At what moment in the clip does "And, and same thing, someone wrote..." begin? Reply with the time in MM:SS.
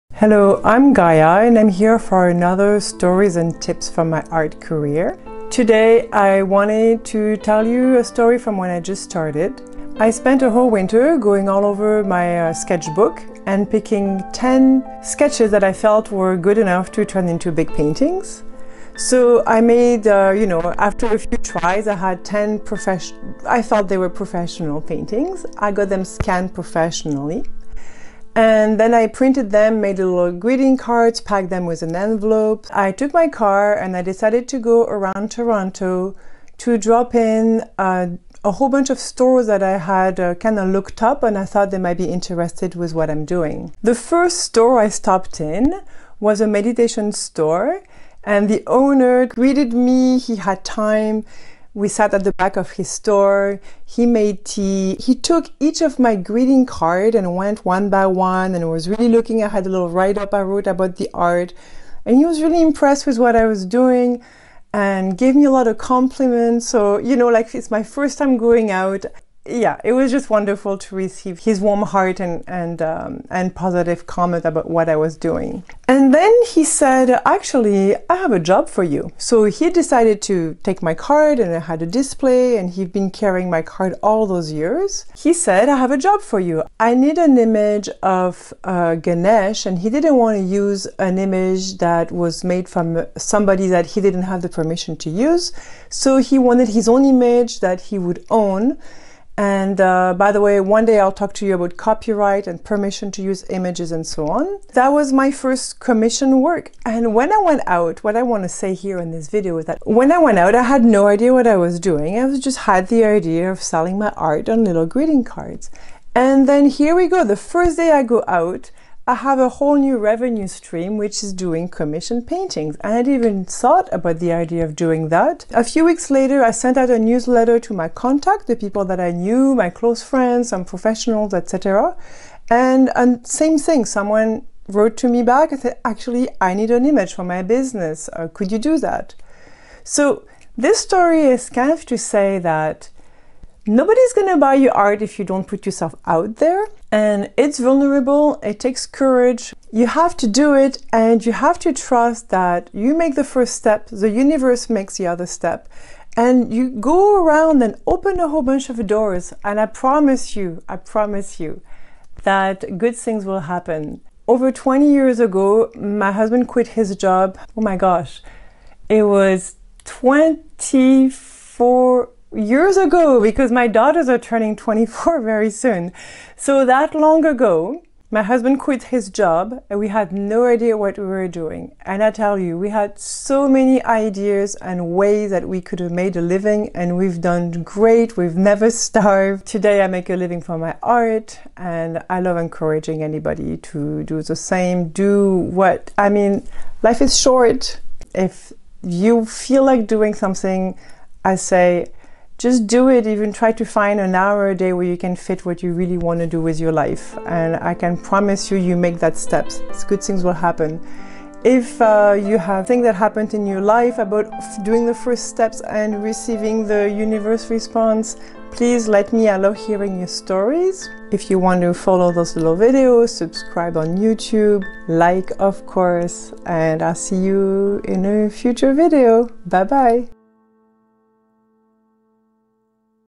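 02:12.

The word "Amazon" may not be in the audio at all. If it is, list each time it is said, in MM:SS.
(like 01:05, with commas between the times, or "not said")
not said.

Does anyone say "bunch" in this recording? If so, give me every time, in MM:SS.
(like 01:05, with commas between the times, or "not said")
00:38, 02:38.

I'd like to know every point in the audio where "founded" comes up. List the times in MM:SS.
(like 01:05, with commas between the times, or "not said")
not said.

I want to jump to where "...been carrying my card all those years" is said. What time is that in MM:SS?
01:22.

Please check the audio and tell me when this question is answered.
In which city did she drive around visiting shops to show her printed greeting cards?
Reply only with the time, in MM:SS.
00:35.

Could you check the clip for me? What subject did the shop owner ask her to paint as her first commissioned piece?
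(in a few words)
Ganesh.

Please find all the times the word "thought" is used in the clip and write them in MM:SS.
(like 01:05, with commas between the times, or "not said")
00:23, 00:41, 02:03.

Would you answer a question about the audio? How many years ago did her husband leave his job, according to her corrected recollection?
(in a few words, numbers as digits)
24.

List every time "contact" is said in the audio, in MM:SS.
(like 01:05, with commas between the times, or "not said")
02:07.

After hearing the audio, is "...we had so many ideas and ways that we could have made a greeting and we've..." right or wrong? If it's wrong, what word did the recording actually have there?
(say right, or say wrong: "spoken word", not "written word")
wrong: "living", not "greeting".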